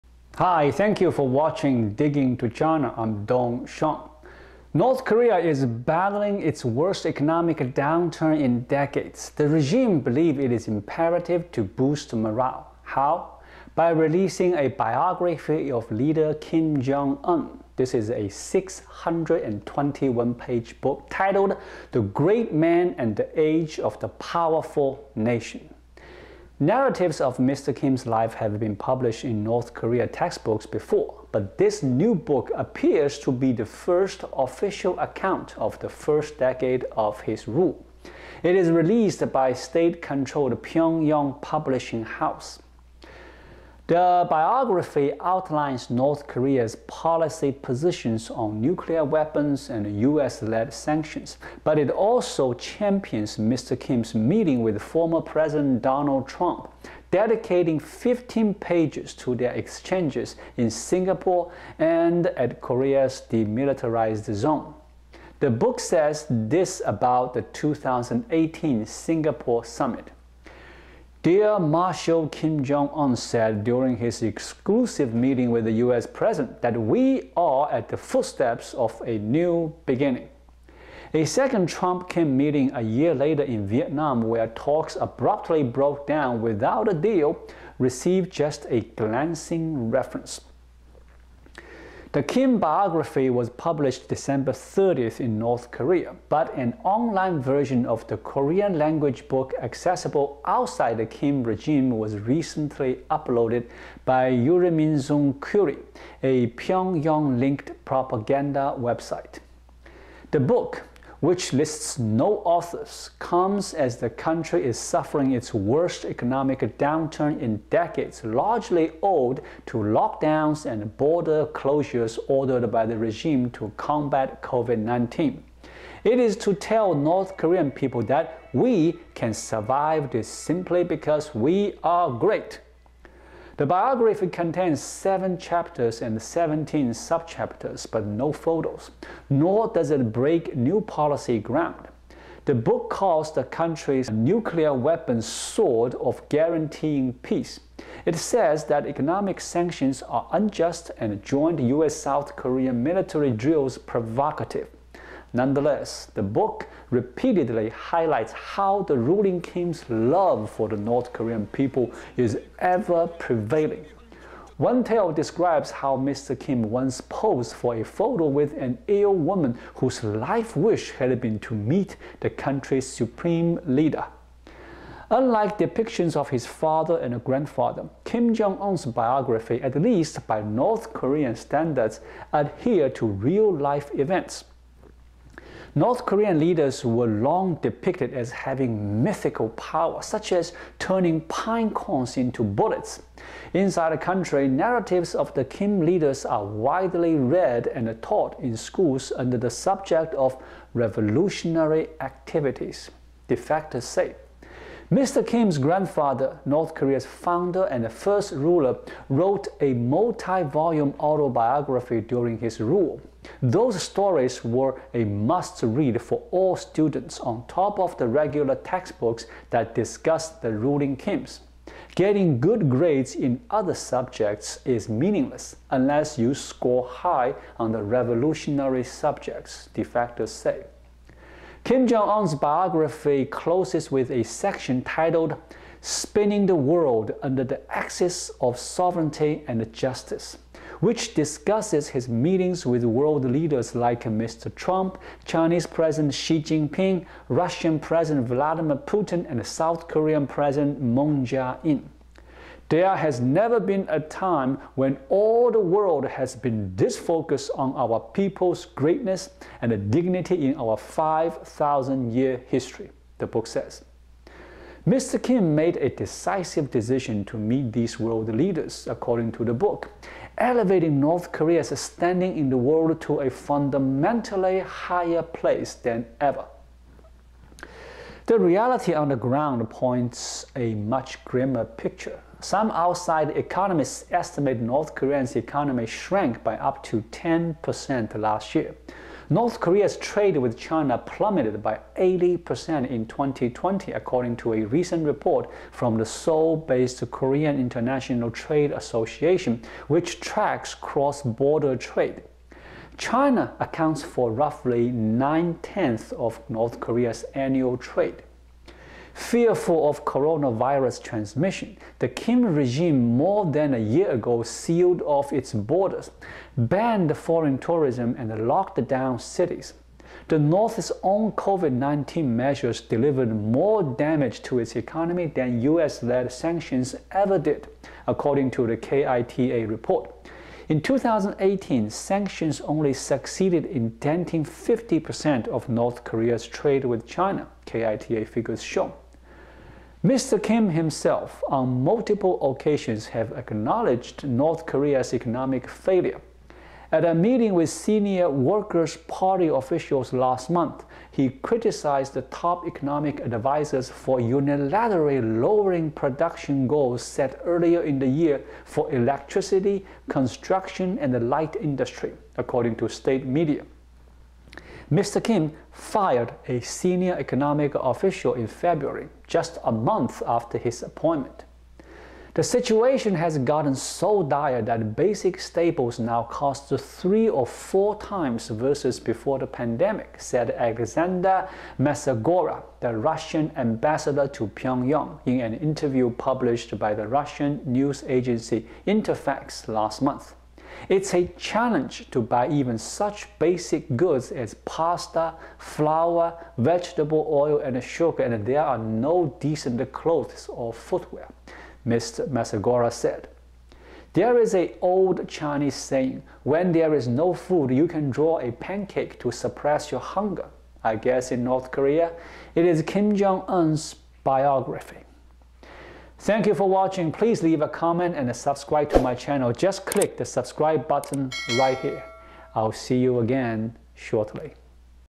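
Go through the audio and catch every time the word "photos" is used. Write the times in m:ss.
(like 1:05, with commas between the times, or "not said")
2:18, 2:47.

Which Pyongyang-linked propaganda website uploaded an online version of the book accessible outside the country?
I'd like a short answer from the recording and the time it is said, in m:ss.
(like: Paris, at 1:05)
Uriminzokkiri, at 1:44.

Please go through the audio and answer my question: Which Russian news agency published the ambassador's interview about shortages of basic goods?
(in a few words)
Interfax.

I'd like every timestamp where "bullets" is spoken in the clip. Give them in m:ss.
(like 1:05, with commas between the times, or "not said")
3:12.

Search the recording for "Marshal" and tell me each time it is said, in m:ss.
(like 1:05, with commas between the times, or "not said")
1:11.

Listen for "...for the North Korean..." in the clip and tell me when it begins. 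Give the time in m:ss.
2:40.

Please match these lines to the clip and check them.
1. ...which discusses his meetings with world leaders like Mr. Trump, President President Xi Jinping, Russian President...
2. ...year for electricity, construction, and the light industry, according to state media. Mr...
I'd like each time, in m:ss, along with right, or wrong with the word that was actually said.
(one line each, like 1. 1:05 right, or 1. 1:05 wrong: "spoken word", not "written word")
1. 4:00 wrong: "Chinese", not "President"
2. 5:58 right.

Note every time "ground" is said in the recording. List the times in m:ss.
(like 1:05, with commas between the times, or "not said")
2:21, 4:39.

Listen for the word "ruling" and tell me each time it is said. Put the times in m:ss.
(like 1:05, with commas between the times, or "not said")
2:38, 3:40.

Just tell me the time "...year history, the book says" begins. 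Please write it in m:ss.
4:22.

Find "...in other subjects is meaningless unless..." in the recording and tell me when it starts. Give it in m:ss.
3:43.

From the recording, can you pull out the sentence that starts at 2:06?
It is to tell North Korean people that we can survive this simply because we are great.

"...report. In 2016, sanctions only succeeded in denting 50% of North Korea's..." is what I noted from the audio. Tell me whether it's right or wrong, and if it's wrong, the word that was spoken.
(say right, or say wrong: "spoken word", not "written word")
wrong: "2018", not "2016".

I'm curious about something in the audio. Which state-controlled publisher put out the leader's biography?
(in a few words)
Pyongyang Publishing House.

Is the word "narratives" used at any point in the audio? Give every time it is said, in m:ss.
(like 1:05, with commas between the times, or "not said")
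0:26, 3:14.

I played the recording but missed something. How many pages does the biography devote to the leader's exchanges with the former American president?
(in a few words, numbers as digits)
15.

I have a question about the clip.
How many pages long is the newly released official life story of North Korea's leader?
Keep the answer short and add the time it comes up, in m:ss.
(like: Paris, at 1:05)
621, at 0:18.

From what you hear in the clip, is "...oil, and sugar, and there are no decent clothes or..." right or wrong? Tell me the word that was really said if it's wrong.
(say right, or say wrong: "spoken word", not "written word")
right.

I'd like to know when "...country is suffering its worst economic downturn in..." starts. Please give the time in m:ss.
1:54.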